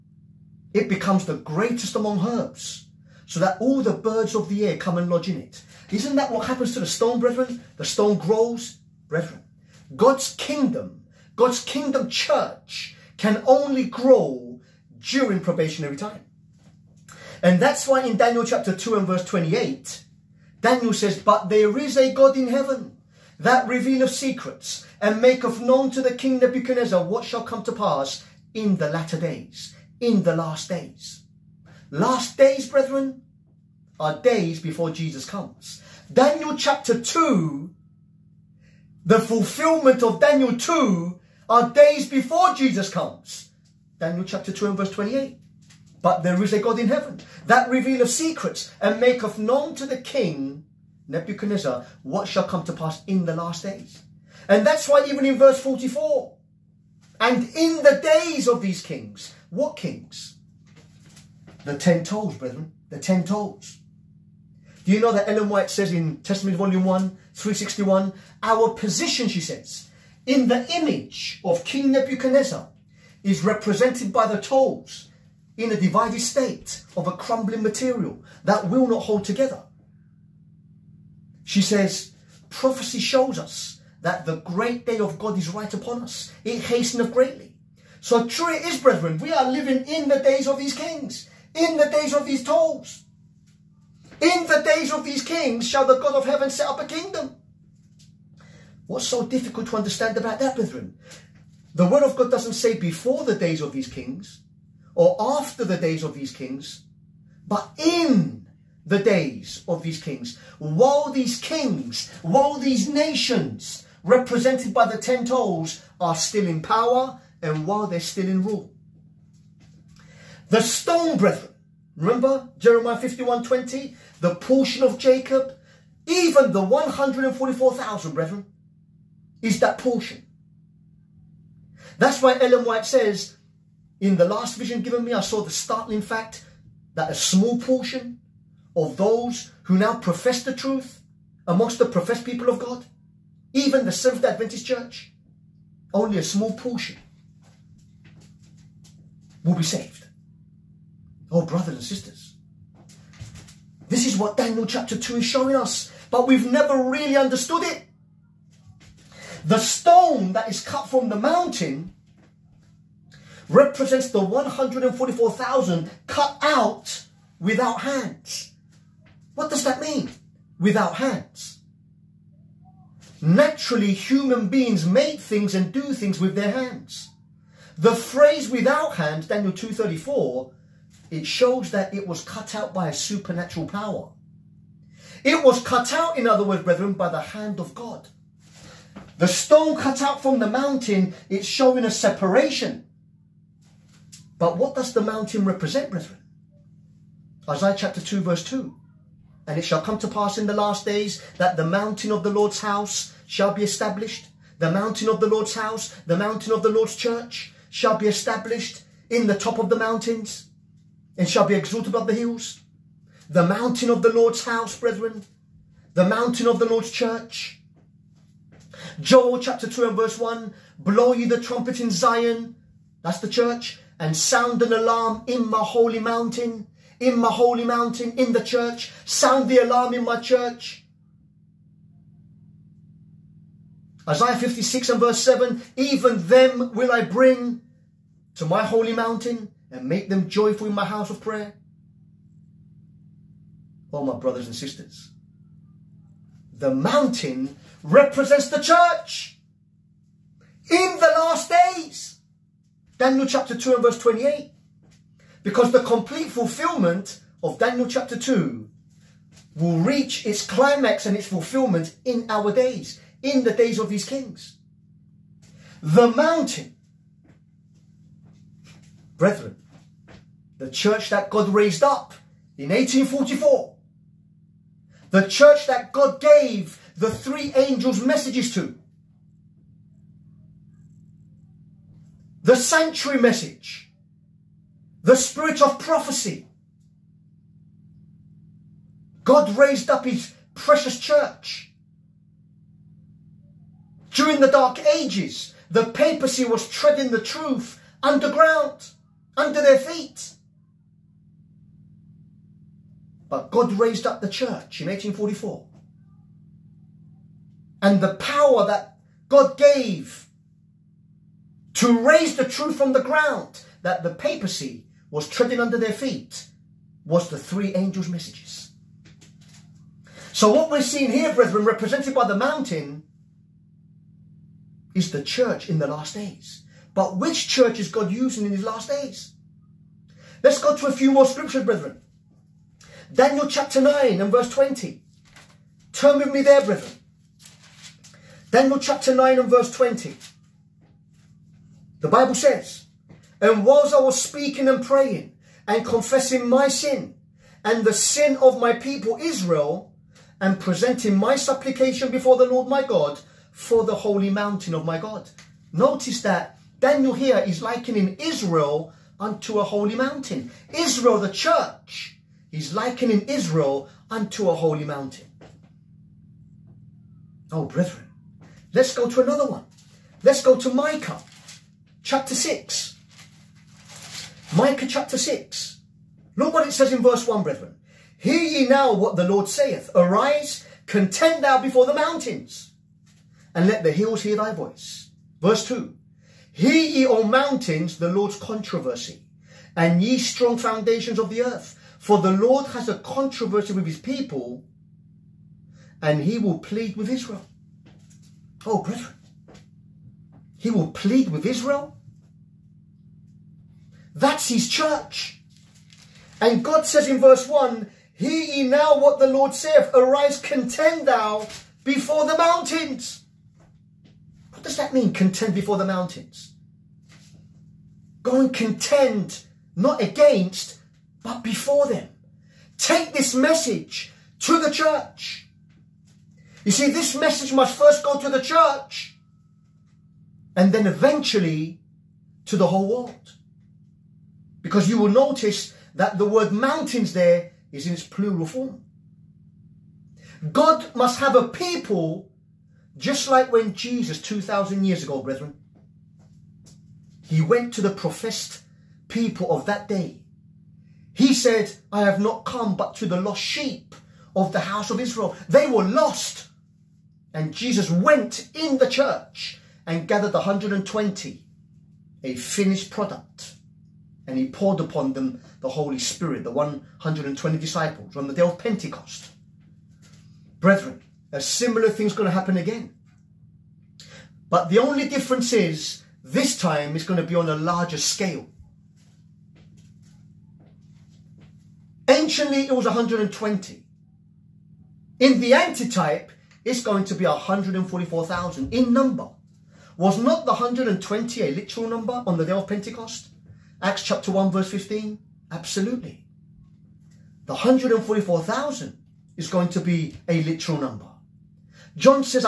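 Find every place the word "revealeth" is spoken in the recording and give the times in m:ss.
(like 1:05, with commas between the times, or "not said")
0:23, 0:47.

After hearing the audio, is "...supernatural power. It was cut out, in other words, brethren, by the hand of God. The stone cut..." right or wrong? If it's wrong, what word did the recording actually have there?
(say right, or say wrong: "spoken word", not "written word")
right.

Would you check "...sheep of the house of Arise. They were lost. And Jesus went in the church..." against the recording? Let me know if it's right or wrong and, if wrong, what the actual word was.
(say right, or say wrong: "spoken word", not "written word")
wrong: "Israel", not "Arise".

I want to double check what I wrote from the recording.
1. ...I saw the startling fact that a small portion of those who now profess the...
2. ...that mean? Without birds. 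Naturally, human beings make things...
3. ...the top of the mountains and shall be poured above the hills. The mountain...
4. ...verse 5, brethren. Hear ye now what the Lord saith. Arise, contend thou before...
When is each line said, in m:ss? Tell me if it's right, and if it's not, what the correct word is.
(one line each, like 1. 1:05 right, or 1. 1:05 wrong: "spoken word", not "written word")
1. 2:15 right
2. 2:49 wrong: "hands", not "birds"
3. 3:29 wrong: "exalted", not "poured"
4. 6:17 wrong: "1", not "5".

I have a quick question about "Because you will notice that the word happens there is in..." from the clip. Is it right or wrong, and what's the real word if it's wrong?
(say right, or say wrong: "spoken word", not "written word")
wrong: "mountains", not "happens".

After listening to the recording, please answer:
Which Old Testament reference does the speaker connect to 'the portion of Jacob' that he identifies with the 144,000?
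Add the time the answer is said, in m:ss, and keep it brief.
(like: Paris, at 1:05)
Jeremiah 51:20, at 2:02.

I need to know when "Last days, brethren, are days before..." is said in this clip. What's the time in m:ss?
0:31.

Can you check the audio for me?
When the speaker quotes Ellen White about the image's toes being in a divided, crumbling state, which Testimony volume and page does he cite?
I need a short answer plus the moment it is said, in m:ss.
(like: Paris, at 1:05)
Volume 1, 361, at 1:06.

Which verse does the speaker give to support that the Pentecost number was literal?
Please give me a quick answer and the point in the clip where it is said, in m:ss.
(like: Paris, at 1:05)
Acts 1:15, at 8:13.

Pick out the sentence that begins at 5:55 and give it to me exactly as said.
Notice that Daniel here is likening Israel unto a holy mountain.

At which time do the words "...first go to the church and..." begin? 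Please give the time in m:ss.
7:07.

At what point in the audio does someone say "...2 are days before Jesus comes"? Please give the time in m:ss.
0:40.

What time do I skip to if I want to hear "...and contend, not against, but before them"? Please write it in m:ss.
6:58.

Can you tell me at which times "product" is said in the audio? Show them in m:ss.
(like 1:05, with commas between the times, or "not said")
7:42.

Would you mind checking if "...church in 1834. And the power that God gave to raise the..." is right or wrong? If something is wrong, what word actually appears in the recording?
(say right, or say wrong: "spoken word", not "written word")
wrong: "1844", not "1834".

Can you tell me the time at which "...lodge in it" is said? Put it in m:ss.
0:05.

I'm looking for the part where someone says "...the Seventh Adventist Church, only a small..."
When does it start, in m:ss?
2:23.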